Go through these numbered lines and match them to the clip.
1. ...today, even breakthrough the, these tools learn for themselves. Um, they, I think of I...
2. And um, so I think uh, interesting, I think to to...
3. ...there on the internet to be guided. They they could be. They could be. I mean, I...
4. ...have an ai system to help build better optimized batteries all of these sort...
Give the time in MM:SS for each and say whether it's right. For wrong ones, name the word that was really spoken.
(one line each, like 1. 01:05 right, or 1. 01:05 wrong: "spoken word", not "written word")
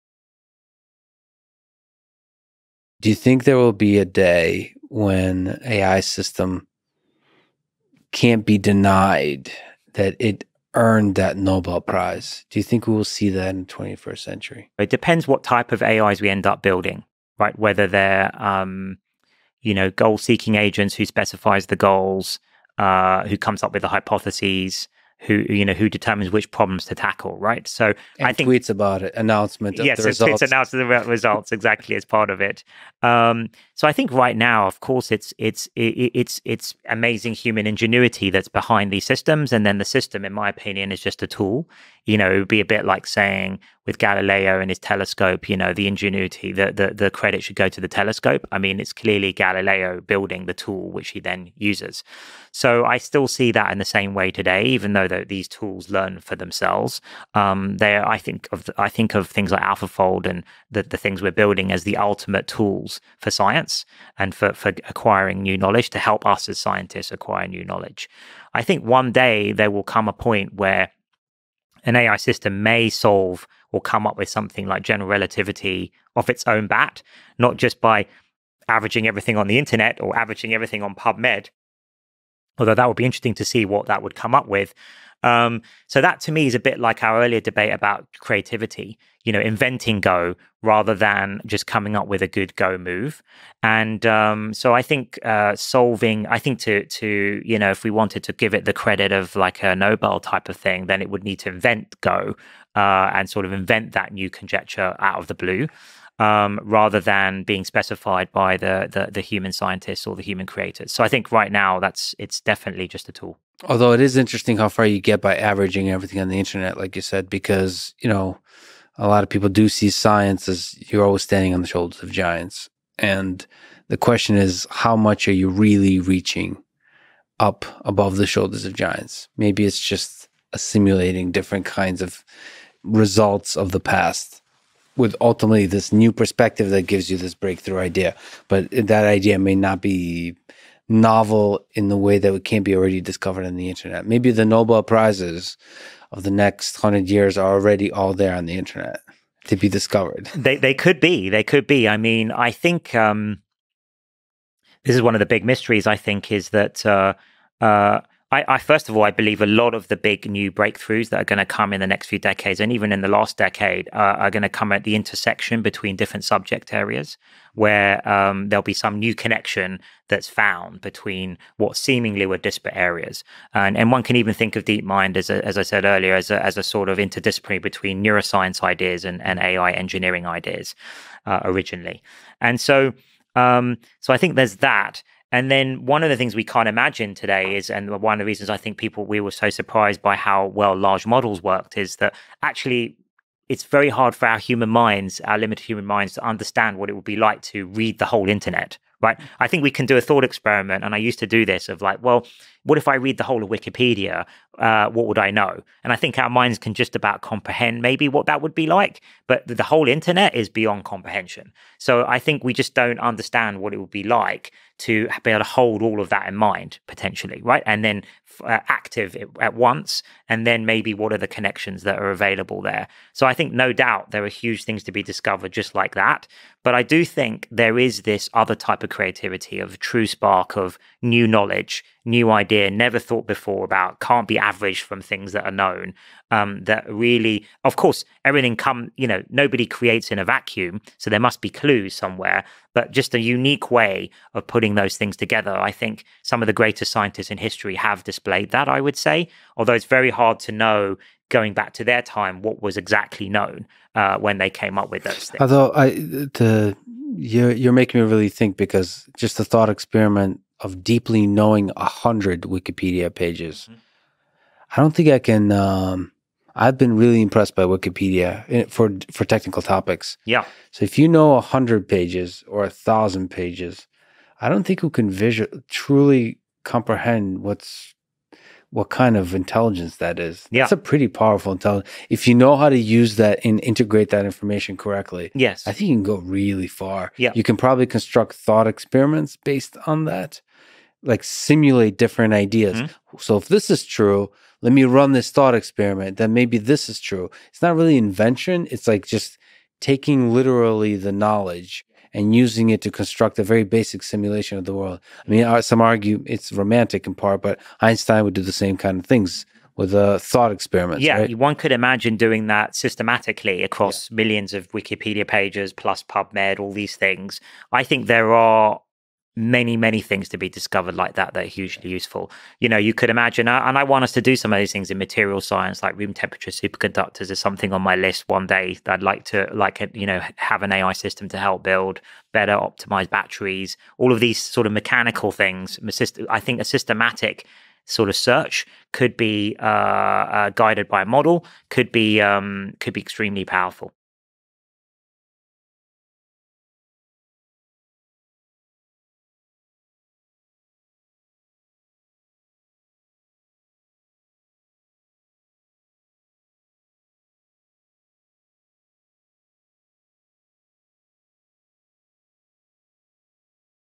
1. 00:54 wrong: "though", not "breakthrough"
2. 01:33 wrong: "solving", not "interesting"
3. 02:28 wrong: "discovered", not "guided"
4. 05:30 right.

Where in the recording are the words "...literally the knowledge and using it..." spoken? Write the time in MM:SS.
05:00.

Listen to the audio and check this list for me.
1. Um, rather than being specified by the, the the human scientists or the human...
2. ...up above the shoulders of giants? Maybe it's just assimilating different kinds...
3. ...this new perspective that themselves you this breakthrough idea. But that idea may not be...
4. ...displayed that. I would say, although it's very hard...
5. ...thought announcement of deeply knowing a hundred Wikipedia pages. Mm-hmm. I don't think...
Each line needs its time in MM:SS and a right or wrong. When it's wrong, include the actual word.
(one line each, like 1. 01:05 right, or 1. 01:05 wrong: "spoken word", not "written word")
1. 01:46 right
2. 02:07 right
3. 02:15 wrong: "gives", not "themselves"
4. 04:08 right
5. 04:19 wrong: "experiment", not "announcement".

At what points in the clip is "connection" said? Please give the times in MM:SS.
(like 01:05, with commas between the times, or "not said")
02:49, 03:41.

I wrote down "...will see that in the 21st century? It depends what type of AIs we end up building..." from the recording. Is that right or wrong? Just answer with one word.
right.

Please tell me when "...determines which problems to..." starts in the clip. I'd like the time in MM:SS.
00:25.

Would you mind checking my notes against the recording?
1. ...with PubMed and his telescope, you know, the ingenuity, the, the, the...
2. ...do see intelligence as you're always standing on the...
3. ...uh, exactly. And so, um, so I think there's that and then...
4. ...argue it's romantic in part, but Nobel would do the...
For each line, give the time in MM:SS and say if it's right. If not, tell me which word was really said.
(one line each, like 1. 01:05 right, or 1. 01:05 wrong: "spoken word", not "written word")
1. 00:43 wrong: "Galileo", not "PubMed"
2. 01:59 wrong: "science", not "intelligence"
3. 03:01 wrong: "originally", not "exactly"
4. 05:05 wrong: "Einstein", not "Nobel".